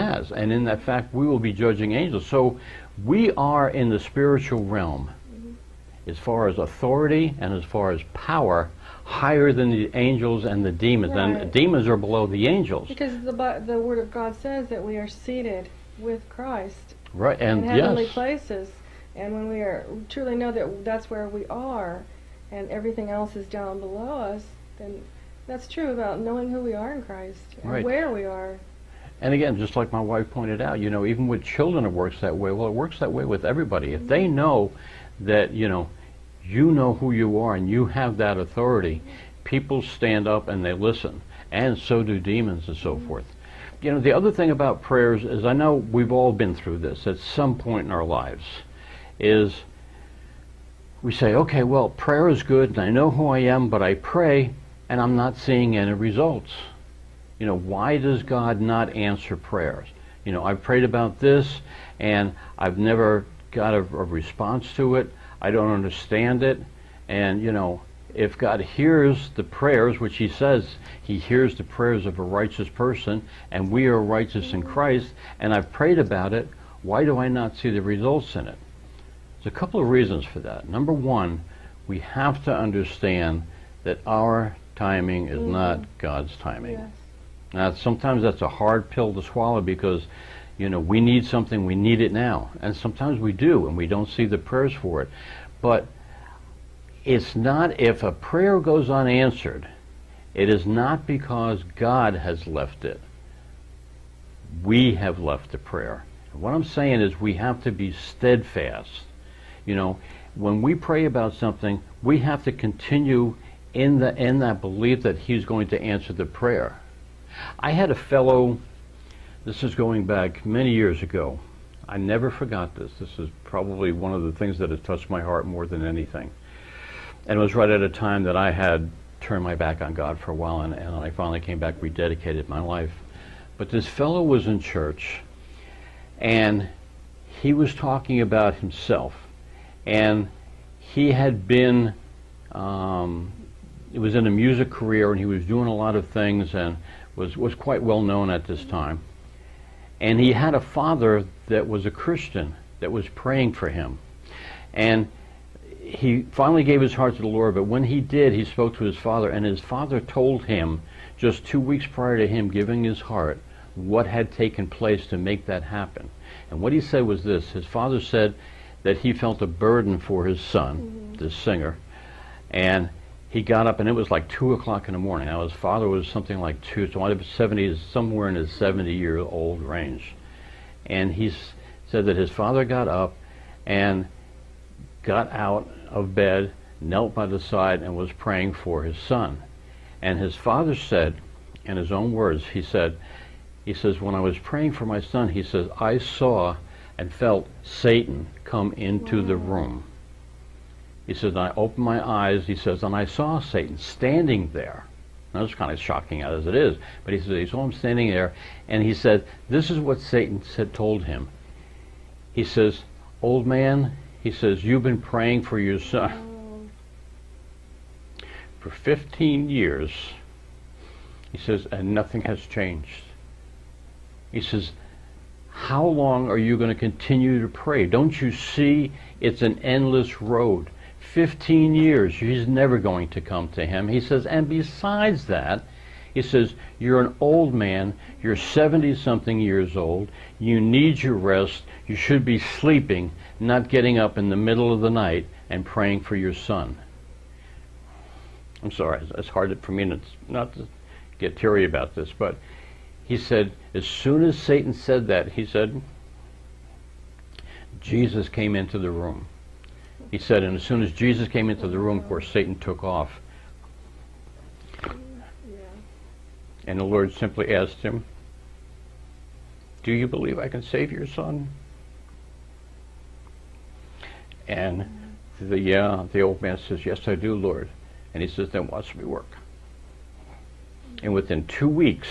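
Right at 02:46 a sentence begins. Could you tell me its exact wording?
And what he said was this his father said that he felt a burden for his son, mm -hmm.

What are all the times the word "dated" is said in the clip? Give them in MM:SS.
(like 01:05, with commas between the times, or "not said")
not said.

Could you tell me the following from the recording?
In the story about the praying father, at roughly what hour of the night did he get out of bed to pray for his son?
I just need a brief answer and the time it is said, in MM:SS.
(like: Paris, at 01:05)
2 o'clock, at 02:54.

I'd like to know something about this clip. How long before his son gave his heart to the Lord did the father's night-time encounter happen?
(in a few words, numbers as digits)
two weeks.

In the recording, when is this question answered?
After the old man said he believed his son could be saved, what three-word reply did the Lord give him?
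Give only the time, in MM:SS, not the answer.
04:38.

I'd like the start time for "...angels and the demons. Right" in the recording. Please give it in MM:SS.
00:09.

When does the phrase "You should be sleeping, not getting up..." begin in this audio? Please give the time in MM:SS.
04:01.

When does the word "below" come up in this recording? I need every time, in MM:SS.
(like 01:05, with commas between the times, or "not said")
00:11, 00:23.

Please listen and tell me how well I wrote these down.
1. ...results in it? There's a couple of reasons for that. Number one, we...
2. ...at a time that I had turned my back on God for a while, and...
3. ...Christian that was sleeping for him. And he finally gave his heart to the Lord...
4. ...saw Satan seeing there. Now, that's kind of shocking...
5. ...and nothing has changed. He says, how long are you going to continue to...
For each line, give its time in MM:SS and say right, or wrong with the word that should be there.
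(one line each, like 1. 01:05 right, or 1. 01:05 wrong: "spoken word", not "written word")
1. 01:17 right
2. 02:07 right
3. 02:31 wrong: "praying", not "sleeping"
4. 03:23 wrong: "standing", not "seeing"
5. 03:41 right.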